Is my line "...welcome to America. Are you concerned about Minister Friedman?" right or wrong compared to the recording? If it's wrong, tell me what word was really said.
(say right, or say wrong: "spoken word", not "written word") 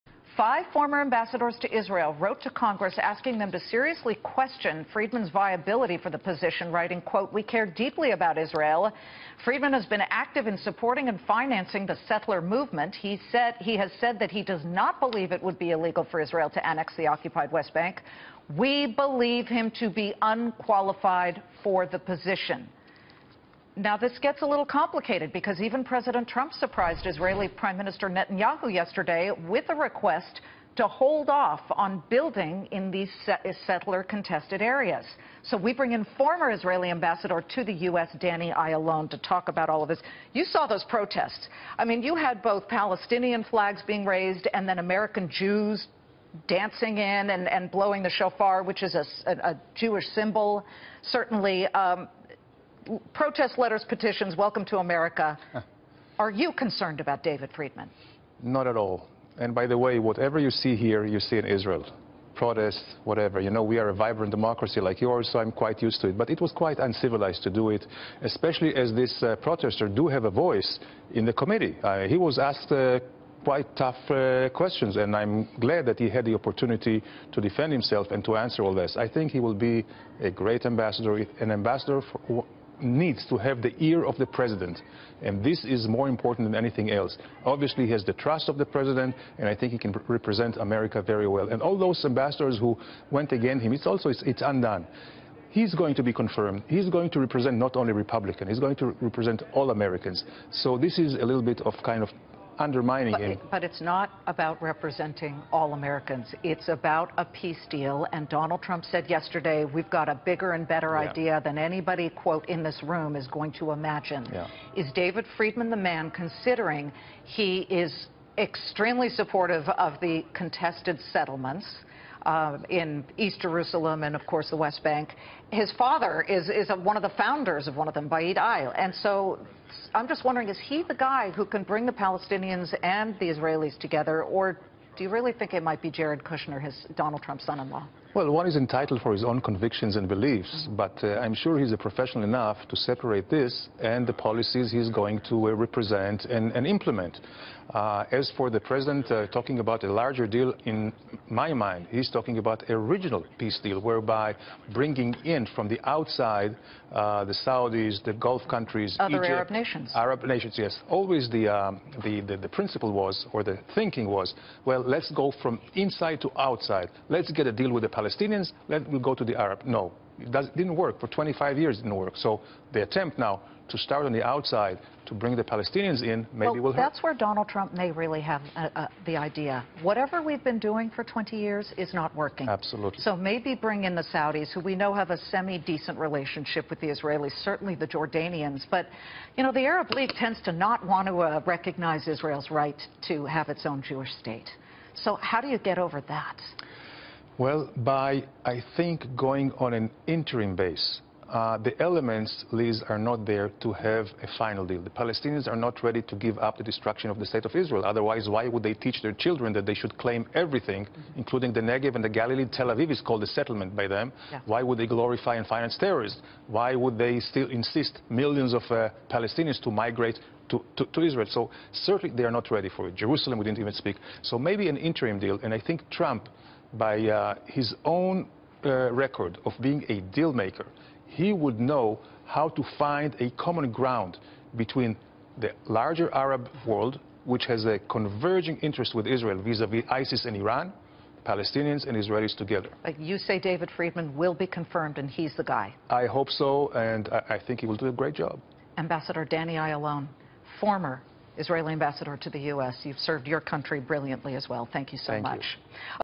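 wrong: "David", not "Minister".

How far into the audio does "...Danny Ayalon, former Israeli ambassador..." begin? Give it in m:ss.
4:09.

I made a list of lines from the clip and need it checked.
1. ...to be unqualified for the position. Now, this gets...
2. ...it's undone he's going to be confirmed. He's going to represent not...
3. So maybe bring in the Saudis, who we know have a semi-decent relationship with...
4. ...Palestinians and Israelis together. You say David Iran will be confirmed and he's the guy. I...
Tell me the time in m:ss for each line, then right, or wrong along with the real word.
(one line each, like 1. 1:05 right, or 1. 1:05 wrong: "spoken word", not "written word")
1. 0:19 right
2. 1:34 right
3. 3:02 right
4. 4:01 wrong: "Friedman", not "Iran".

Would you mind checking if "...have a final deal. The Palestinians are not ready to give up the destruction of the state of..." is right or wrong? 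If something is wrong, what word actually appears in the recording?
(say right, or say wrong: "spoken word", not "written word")
right.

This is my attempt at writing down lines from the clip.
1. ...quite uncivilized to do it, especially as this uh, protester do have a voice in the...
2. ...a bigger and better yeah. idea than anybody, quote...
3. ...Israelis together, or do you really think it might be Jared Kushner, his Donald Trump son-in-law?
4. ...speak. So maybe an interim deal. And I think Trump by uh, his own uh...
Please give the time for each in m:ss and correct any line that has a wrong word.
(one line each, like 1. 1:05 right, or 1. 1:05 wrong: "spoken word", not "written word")
1. 1:06 right
2. 1:50 right
3. 2:13 right
4. 3:43 right.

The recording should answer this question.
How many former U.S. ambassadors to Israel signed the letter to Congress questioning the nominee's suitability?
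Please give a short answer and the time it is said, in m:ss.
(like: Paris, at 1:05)
5, at 0:00.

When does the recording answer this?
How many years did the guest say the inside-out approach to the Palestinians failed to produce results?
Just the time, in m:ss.
2:51.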